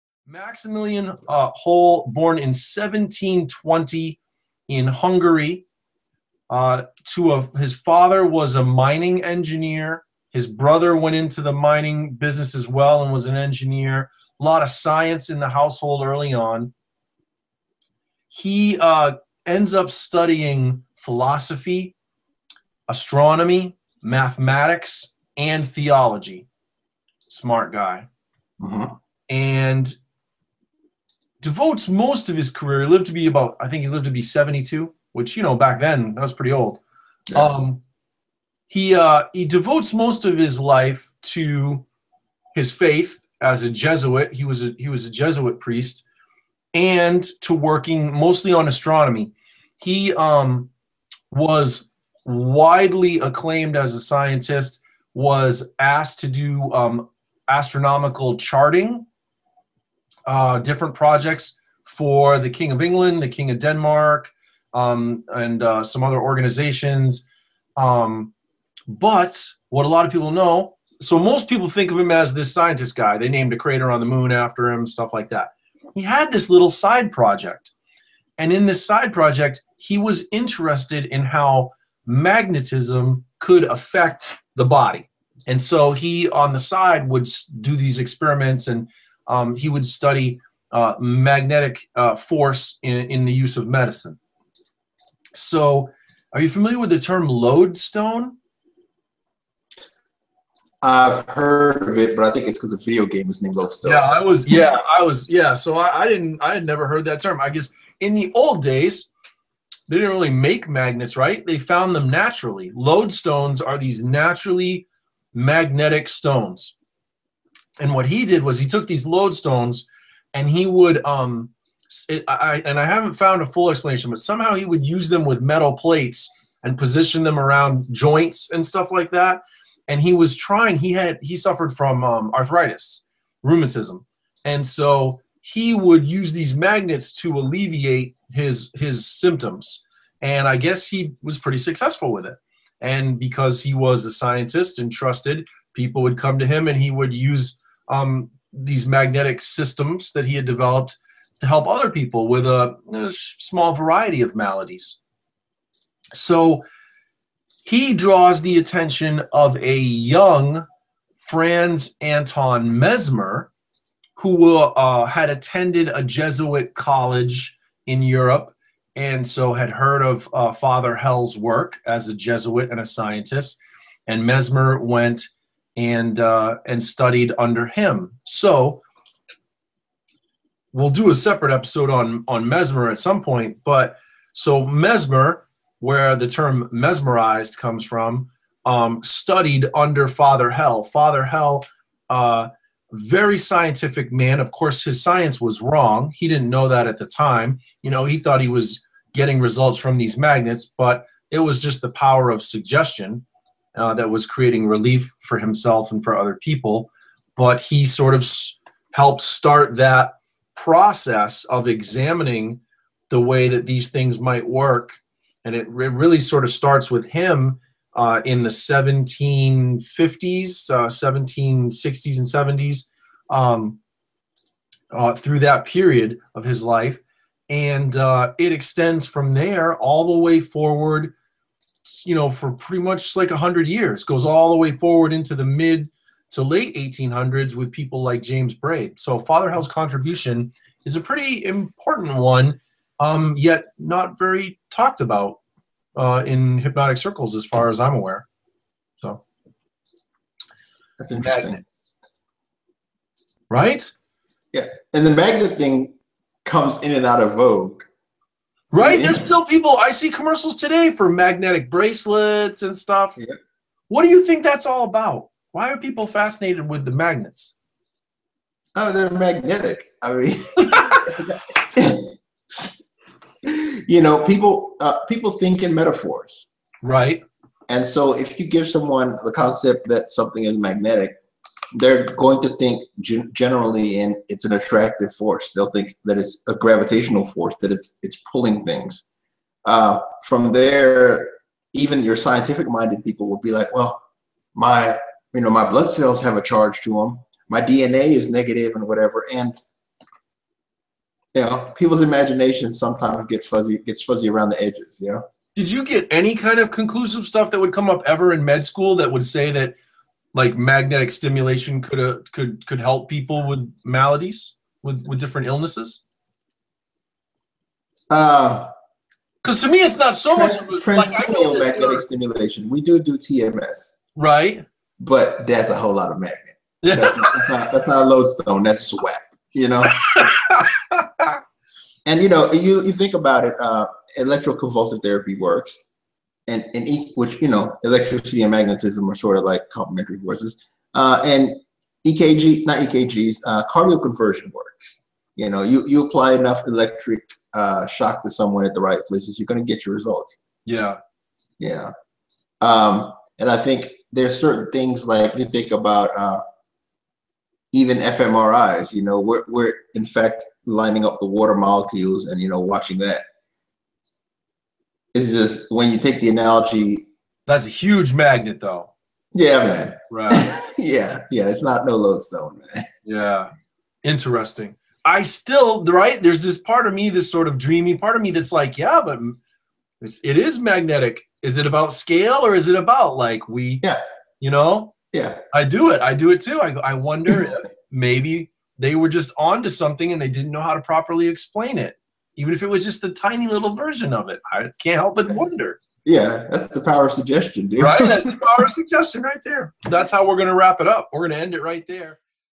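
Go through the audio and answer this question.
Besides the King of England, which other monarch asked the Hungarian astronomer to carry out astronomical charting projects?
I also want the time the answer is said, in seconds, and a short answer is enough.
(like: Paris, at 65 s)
King of Denmark, at 63 s.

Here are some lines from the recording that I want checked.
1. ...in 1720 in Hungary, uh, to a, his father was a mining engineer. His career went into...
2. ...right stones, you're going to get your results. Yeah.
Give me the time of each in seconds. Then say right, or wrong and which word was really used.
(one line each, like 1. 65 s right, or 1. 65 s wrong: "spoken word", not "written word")
1. 2 s wrong: "brother", not "career"
2. 348 s wrong: "places", not "stones".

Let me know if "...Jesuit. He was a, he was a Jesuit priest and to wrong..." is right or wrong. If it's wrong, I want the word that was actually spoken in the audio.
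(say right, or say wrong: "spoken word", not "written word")
wrong: "working", not "wrong".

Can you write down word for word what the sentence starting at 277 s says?
And so, if you give someone the concept that something is magnetic, they're going to think generally in it's an attractive force.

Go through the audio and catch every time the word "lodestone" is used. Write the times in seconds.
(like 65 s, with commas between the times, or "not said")
97 s, 103 s, 112 s, 119 s, 328 s, 371 s.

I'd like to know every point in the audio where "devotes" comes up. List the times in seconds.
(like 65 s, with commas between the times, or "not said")
31 s, 39 s.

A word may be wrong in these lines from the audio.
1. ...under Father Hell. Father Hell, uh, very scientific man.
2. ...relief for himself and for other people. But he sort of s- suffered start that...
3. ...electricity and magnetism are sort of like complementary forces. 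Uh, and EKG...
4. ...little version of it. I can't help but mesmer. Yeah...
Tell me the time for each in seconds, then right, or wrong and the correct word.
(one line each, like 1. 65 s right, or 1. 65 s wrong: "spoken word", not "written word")
1. 189 s right
2. 204 s wrong: "helped", not "suffered"
3. 337 s right
4. 393 s wrong: "wonder", not "mesmer".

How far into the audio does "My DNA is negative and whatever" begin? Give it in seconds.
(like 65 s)
297 s.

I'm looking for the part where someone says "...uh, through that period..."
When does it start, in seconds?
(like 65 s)
224 s.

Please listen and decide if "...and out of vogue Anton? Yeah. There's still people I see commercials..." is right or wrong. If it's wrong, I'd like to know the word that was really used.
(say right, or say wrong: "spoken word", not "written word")
wrong: "Right", not "Anton".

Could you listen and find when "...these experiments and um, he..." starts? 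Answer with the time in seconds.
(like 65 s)
87 s.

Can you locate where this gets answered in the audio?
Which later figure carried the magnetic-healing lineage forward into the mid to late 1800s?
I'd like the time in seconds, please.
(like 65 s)
238 s.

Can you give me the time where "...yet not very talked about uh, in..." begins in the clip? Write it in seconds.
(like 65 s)
243 s.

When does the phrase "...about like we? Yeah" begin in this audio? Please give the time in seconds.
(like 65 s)
382 s.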